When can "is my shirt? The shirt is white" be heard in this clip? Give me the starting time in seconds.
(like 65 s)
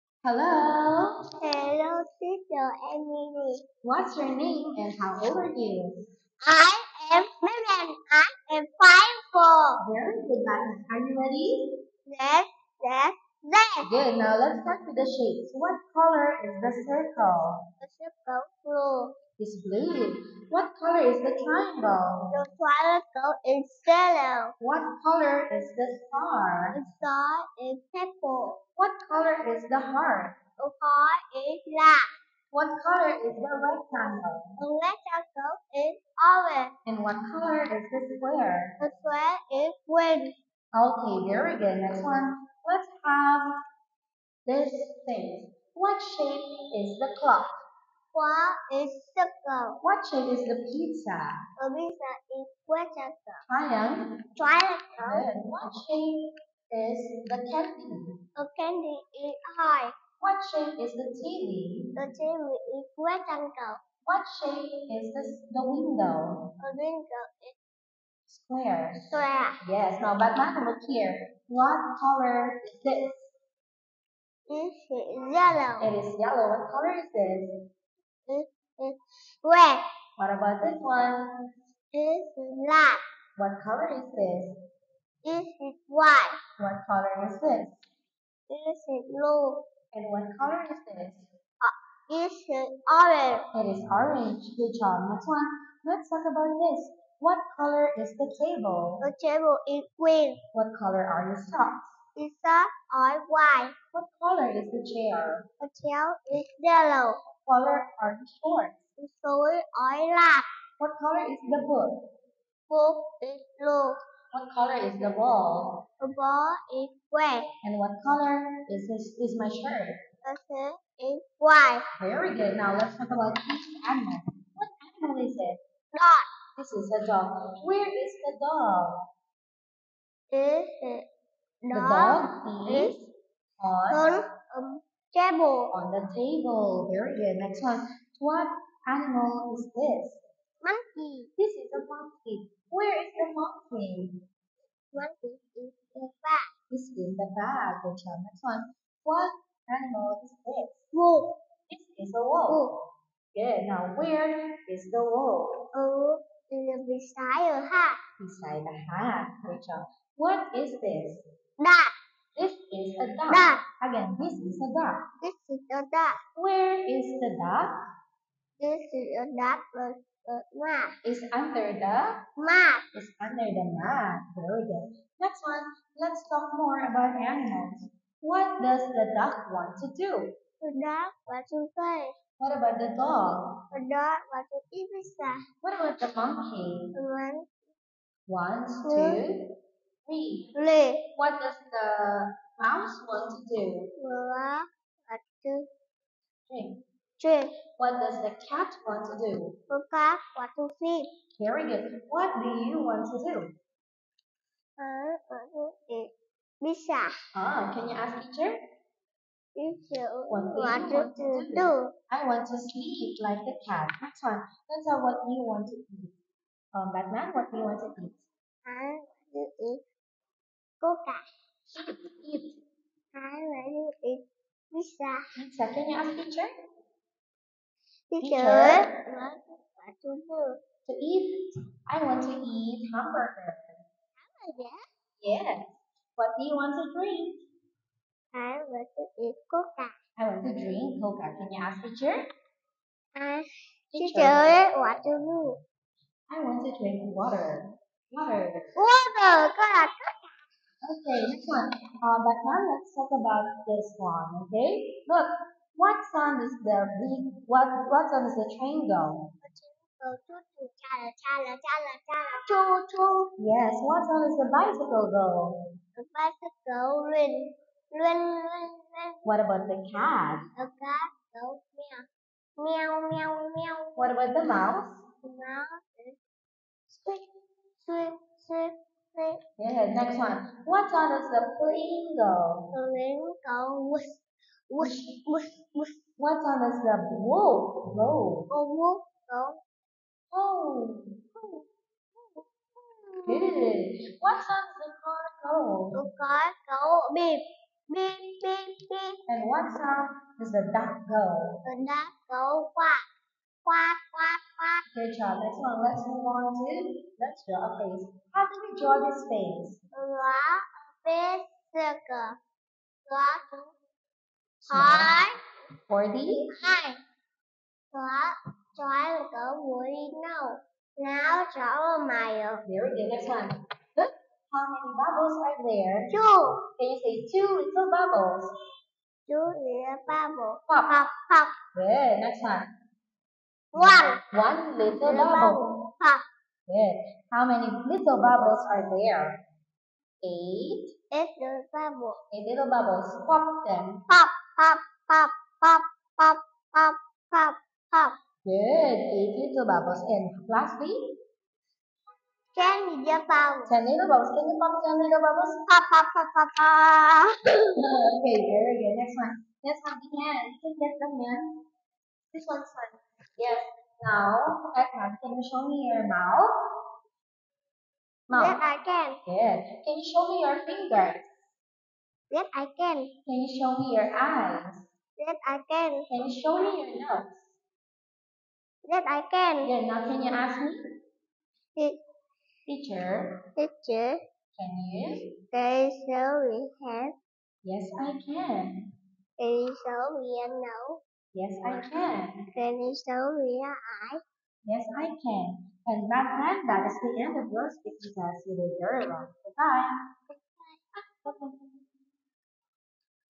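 119 s.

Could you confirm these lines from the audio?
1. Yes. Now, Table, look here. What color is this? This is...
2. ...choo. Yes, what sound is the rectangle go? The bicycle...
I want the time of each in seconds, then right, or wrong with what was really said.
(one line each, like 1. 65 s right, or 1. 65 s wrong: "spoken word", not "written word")
1. 69 s wrong: "Batman", not "Table"
2. 262 s wrong: "bicycle", not "rectangle".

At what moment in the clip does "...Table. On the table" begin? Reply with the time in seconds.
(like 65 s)
135 s.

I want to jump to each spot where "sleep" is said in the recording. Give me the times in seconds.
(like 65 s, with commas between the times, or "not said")
200 s, 212 s.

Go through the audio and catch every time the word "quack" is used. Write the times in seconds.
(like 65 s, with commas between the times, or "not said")
302 s.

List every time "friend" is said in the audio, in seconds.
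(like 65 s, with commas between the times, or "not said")
396 s.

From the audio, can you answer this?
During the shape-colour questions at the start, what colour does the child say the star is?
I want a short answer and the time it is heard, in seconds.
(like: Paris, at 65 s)
Purple, at 26 s.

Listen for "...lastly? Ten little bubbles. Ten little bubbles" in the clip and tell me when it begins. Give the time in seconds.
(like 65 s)
350 s.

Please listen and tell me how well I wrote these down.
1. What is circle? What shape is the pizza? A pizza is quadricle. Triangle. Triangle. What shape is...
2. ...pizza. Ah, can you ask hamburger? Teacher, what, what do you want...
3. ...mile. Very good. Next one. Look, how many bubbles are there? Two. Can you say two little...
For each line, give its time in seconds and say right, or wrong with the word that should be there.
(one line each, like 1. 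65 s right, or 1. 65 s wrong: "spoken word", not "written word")
1. 48 s right
2. 206 s wrong: "teacher", not "hamburger"
3. 322 s right.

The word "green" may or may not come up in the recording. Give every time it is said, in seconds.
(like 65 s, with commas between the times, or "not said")
39 s, 99 s.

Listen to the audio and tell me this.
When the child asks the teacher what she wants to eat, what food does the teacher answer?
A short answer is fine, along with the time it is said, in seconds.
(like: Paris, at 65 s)
Hamburger, at 231 s.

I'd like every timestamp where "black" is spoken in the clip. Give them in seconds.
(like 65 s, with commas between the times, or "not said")
31 s, 82 s, 110 s.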